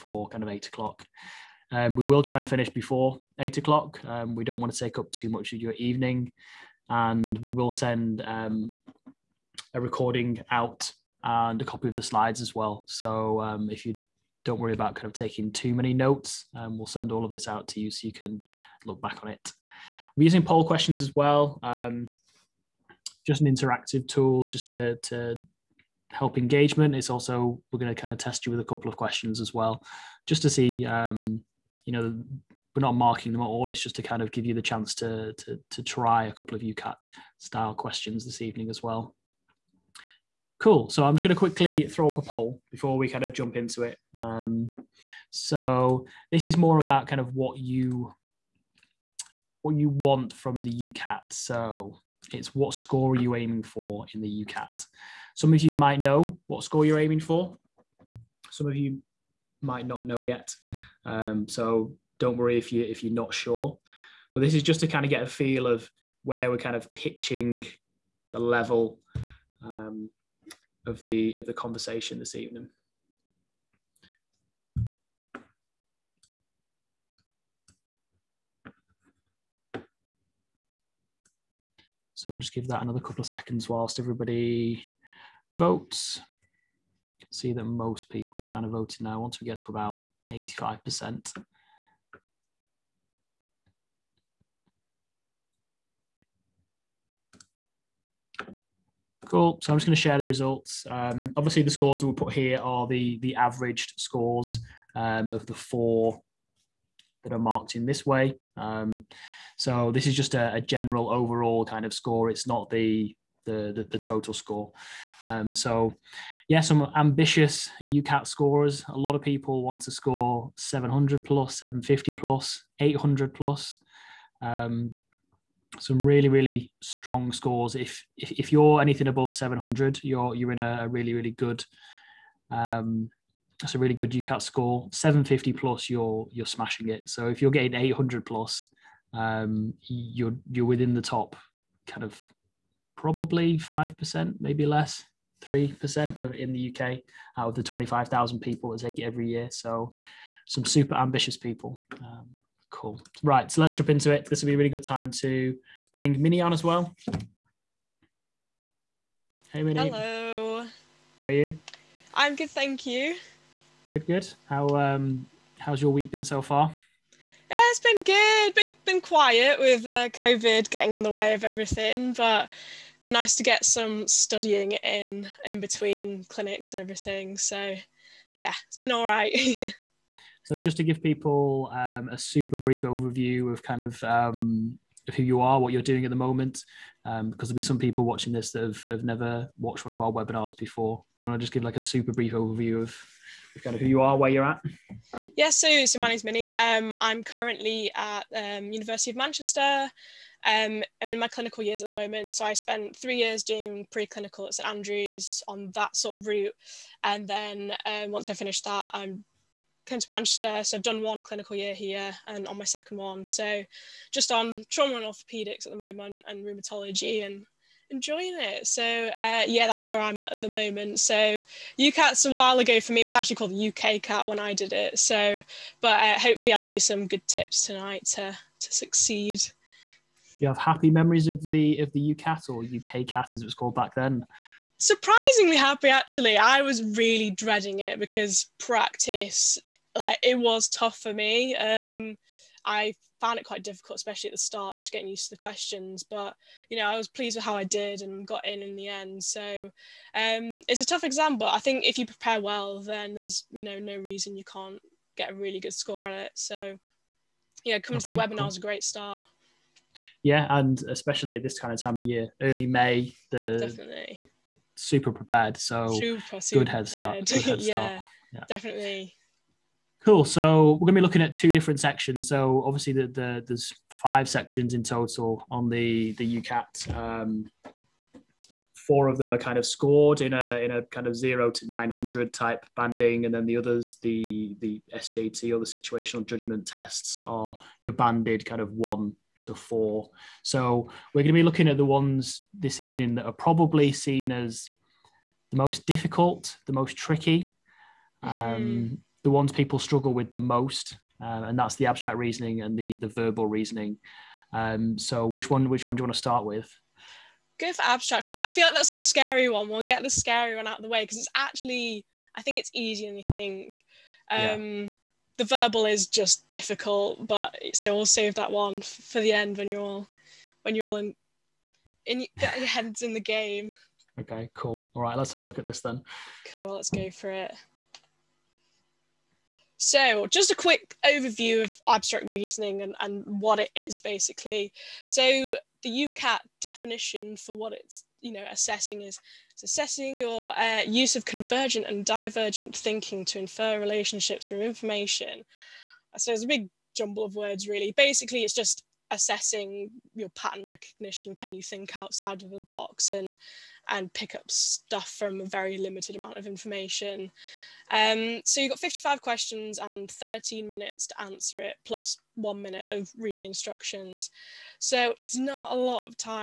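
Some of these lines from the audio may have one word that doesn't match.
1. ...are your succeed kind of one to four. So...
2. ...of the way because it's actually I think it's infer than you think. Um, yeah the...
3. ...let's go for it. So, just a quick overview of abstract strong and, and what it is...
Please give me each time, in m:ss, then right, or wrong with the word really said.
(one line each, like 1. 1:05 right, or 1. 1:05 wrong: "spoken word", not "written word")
1. 4:47 wrong: "banded", not "succeed"
2. 5:10 wrong: "easier", not "infer"
3. 5:26 wrong: "reasoning", not "strong".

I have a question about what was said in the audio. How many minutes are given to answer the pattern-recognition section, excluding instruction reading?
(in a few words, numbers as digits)
13.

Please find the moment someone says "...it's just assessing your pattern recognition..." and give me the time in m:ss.
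5:48.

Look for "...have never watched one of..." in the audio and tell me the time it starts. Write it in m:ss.
3:08.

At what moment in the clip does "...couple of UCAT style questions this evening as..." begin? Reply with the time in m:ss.
0:36.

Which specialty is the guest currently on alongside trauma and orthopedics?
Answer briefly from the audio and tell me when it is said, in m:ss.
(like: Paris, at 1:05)
rheumatology, at 3:36.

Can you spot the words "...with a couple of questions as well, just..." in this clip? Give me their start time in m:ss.
0:28.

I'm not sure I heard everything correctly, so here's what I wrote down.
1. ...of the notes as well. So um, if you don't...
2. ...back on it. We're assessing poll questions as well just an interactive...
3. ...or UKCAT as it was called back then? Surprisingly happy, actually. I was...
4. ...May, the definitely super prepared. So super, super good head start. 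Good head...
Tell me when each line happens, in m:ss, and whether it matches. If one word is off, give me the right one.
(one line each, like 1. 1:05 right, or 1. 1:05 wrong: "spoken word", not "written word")
1. 0:11 wrong: "slides", not "notes"
2. 0:19 wrong: "using", not "assessing"
3. 3:52 right
4. 4:22 right.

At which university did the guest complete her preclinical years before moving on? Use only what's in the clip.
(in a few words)
St Andrews.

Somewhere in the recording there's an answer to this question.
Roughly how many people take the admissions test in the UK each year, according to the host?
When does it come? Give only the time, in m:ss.
2:27.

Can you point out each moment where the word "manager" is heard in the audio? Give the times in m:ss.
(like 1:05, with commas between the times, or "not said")
not said.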